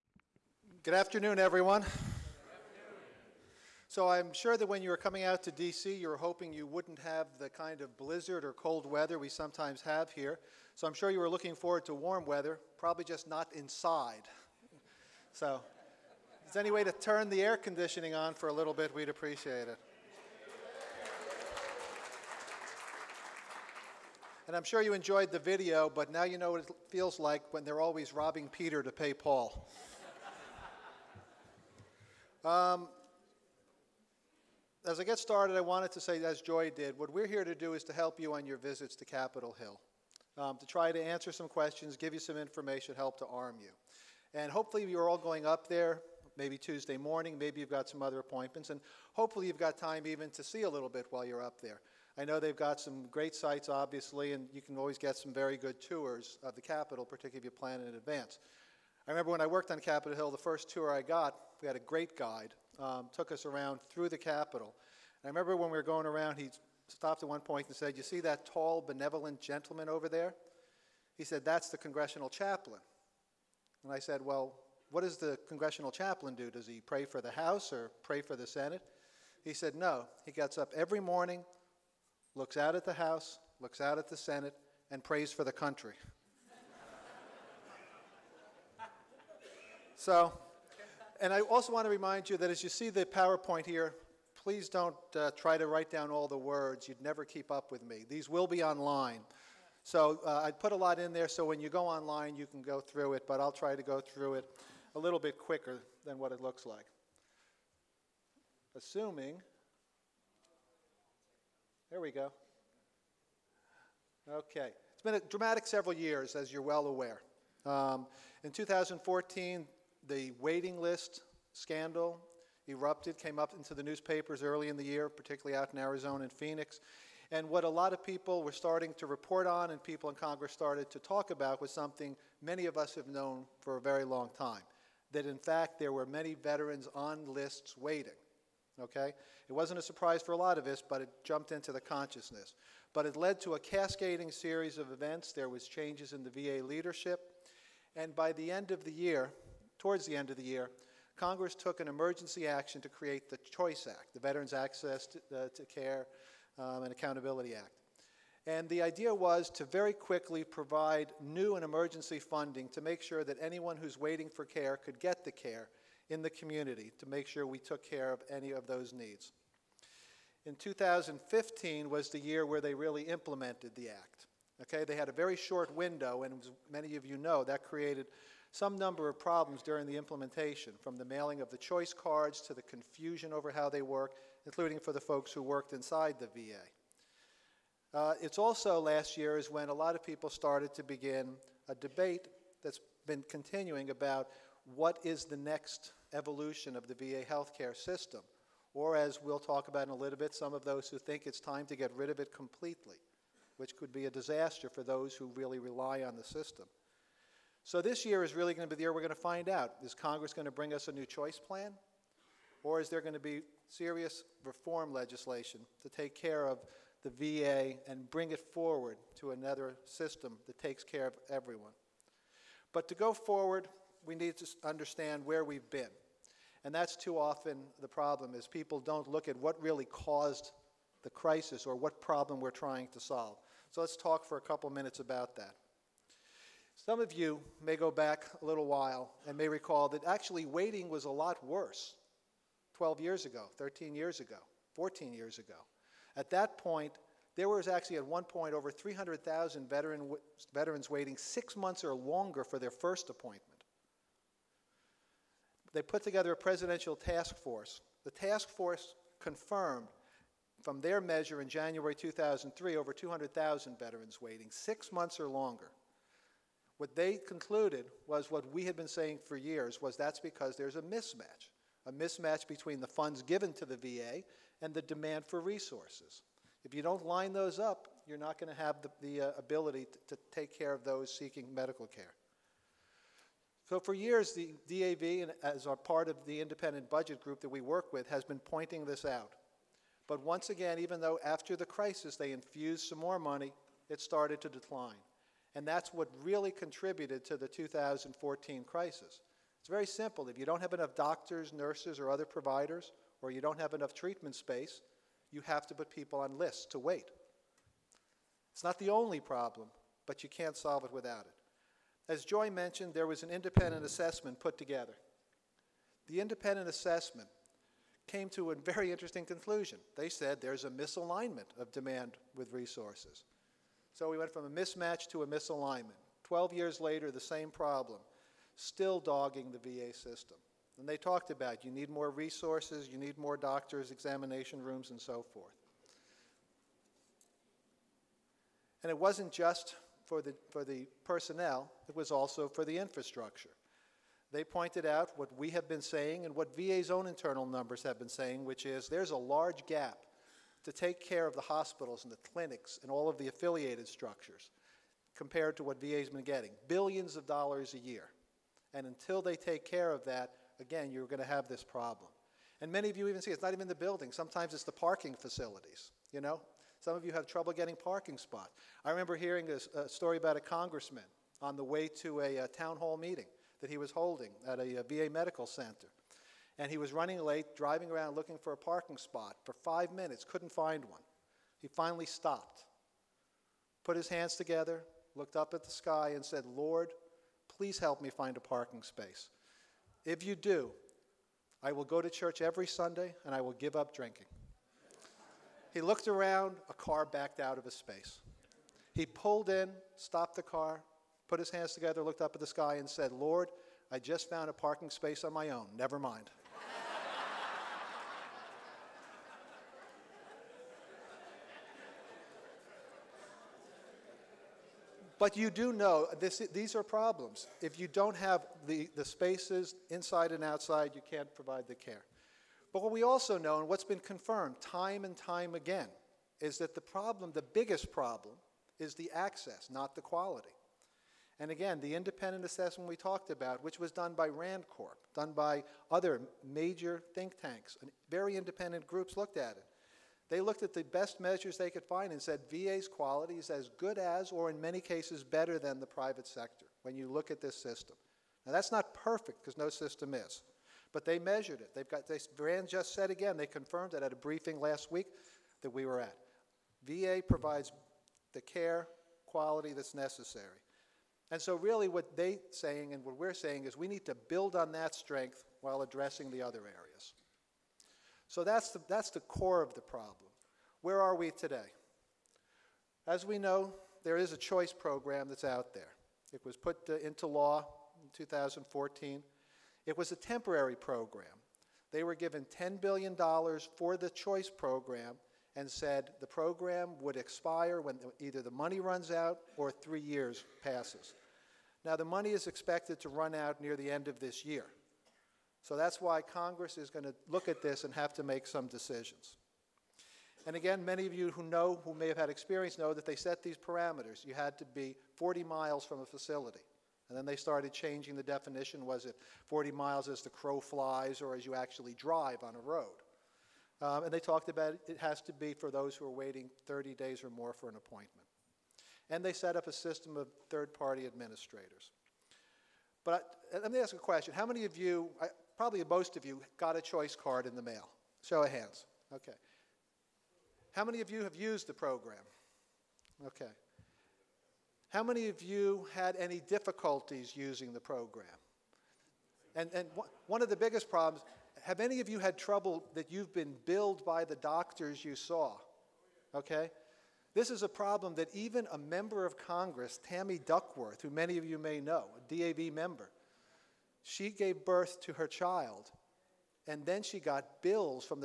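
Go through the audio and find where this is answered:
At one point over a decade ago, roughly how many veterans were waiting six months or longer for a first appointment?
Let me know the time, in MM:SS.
04:08.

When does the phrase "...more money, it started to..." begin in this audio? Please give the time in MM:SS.
04:52.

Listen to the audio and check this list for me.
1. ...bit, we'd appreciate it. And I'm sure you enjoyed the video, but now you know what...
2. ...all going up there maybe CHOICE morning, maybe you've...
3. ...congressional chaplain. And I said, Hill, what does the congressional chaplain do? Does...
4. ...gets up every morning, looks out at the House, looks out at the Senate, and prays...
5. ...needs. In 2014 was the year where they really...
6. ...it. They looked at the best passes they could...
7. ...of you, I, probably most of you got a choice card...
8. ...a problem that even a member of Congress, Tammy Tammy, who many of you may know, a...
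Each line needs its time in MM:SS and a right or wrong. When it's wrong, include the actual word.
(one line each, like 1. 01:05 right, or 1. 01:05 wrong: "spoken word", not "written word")
1. 00:18 right
2. 00:45 wrong: "Tuesday", not "CHOICE"
3. 01:11 wrong: "Well", not "Hill"
4. 01:20 right
5. 02:48 wrong: "2015", not "2014"
6. 07:19 wrong: "measures", not "passes"
7. 08:44 right
8. 09:07 wrong: "Duckworth", not "Tammy".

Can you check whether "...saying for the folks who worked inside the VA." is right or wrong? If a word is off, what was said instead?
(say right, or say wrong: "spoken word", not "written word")
wrong: "including", not "saying".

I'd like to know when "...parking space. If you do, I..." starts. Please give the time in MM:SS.
06:28.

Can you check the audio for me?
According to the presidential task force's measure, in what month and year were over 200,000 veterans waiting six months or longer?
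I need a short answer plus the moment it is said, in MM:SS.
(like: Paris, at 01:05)
January 2003, at 04:21.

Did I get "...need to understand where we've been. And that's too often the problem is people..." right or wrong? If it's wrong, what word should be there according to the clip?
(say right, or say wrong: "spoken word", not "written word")
right.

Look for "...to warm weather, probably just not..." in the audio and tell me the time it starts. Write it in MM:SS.
00:11.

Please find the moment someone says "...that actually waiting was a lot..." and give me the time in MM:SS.
03:59.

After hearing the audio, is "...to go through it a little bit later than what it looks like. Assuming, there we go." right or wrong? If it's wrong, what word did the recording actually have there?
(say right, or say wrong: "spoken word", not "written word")
wrong: "quicker", not "later".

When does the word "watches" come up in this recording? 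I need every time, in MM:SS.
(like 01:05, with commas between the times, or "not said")
not said.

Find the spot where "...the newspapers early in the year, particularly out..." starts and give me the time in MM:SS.
02:03.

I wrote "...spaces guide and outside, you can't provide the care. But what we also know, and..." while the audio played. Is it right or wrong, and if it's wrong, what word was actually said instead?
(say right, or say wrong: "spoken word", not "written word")
wrong: "inside", not "guide".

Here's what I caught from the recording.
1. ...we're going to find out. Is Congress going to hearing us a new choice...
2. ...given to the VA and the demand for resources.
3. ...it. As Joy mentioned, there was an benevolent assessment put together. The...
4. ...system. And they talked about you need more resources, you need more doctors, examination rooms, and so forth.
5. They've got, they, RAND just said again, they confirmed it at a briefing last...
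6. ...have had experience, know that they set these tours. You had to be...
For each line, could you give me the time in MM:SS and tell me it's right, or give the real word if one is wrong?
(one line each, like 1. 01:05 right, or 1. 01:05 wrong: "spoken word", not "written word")
1. 03:28 wrong: "bring", not "hearing"
2. 04:33 right
3. 05:11 wrong: "independent", not "benevolent"
4. 05:29 right
5. 07:31 right
6. 08:22 wrong: "parameters", not "tours".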